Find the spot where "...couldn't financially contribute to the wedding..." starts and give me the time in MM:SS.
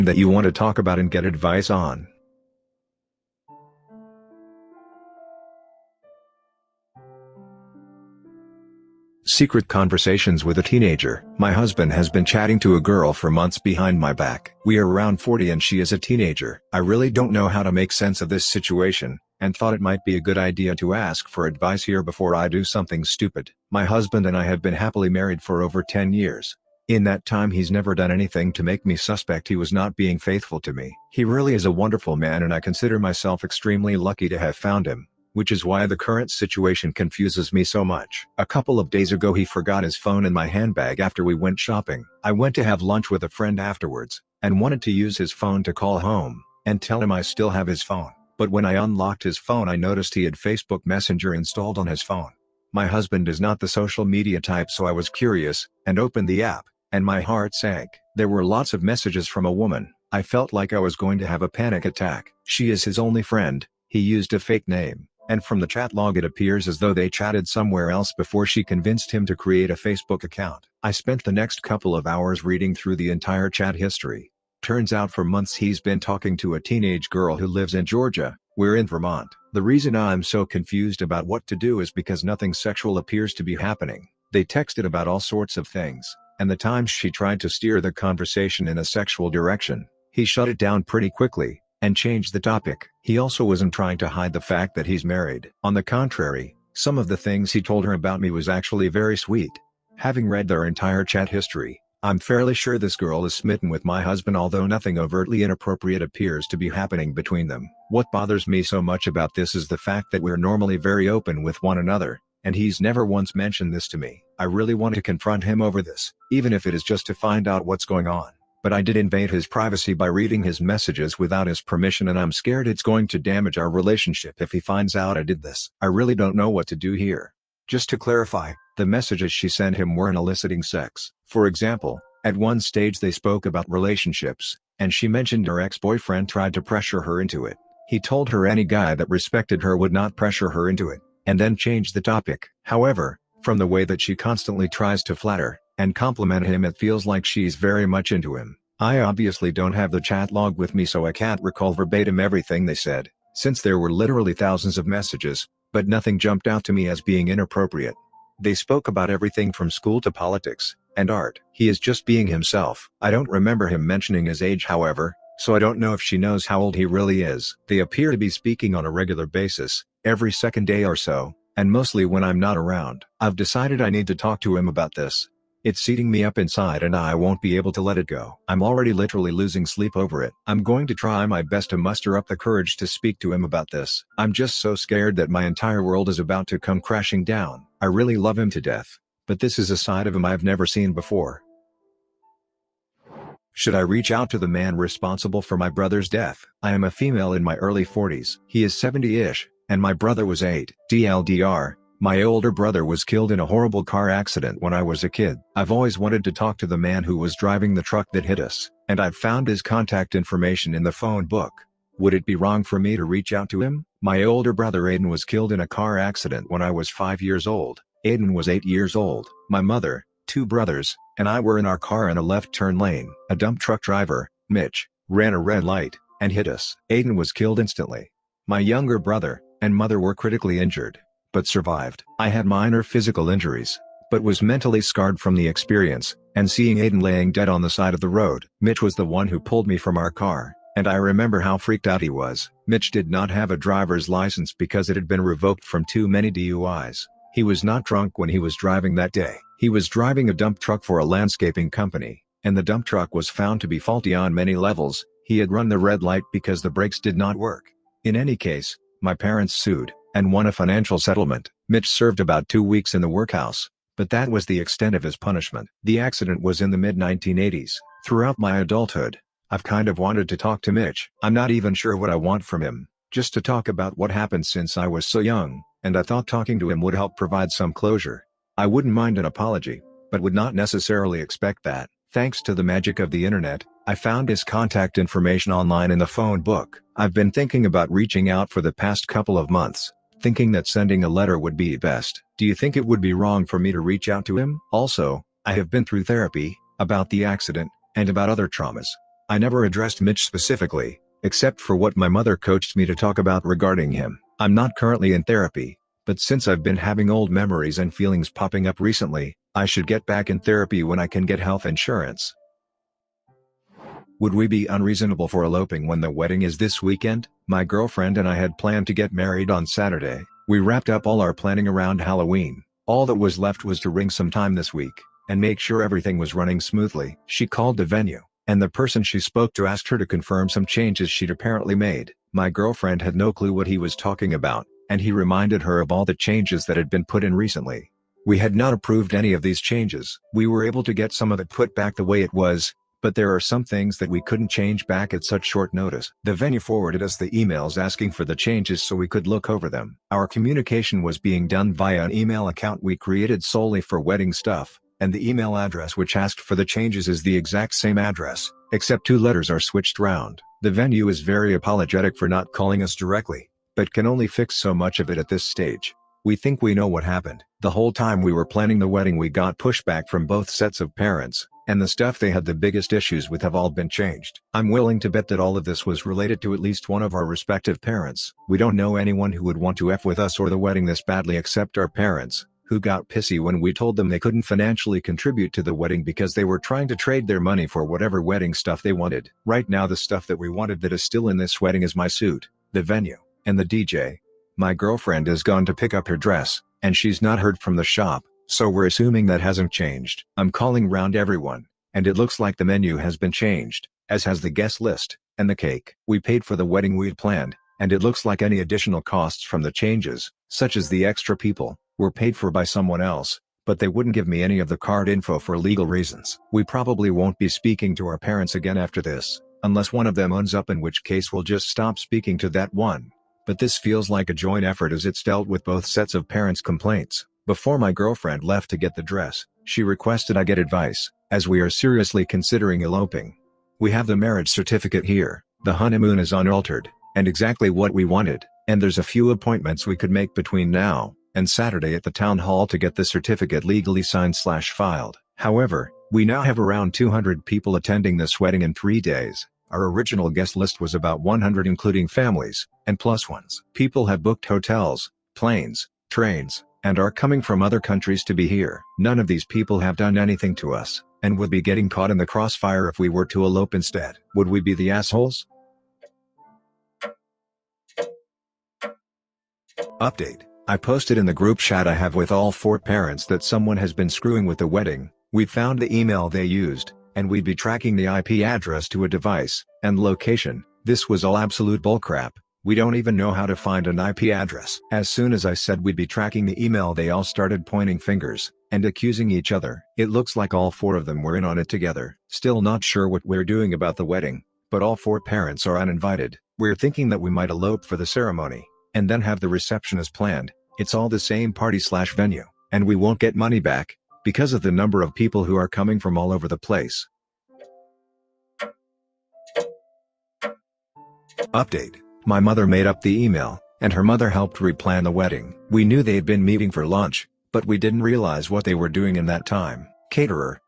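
06:24.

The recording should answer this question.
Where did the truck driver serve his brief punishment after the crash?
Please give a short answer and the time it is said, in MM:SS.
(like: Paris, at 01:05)
the workhouse, at 04:23.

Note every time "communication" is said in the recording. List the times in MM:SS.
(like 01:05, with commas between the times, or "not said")
05:50.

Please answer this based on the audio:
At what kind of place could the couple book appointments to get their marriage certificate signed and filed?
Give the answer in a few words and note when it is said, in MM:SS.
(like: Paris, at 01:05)
town hall, at 07:22.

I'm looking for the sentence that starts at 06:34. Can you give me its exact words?
My girlfriend has gone to pick up her dress, and she's not heard from the shop, so we're assuming that hasn't changed.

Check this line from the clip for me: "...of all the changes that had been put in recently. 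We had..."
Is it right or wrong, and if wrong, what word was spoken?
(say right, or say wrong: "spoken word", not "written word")
right.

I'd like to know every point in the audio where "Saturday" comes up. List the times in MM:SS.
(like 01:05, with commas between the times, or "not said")
05:19, 07:21.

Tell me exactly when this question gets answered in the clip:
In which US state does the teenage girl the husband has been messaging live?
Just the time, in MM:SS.
01:17.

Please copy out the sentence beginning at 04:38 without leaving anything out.
I wouldn't mind an apology, but would not necessarily expect that.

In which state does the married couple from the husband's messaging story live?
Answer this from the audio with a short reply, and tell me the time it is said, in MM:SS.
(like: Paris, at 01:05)
Vermont, at 01:18.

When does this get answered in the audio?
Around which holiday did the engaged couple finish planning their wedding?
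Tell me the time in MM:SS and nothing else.
05:22.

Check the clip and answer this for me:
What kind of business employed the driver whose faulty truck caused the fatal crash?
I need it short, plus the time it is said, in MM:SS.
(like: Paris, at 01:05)
landscaping company, at 04:11.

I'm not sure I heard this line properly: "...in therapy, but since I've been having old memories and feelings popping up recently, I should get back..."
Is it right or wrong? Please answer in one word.
right.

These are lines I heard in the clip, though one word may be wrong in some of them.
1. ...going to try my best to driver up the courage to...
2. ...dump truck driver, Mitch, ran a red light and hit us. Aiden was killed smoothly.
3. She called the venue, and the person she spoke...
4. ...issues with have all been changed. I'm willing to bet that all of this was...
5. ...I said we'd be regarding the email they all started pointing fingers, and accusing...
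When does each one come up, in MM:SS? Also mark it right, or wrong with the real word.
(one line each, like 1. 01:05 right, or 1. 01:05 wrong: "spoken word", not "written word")
1. 03:00 wrong: "muster", not "driver"
2. 03:43 wrong: "instantly", not "smoothly"
3. 05:27 right
4. 06:12 right
5. 08:05 wrong: "tracking", not "regarding".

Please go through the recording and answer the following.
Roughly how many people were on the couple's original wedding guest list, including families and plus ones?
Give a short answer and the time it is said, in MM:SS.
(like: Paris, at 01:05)
100, at 07:31.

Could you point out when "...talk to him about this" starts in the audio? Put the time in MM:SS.
02:54.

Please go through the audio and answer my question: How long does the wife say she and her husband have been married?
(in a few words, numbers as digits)
over 10 years.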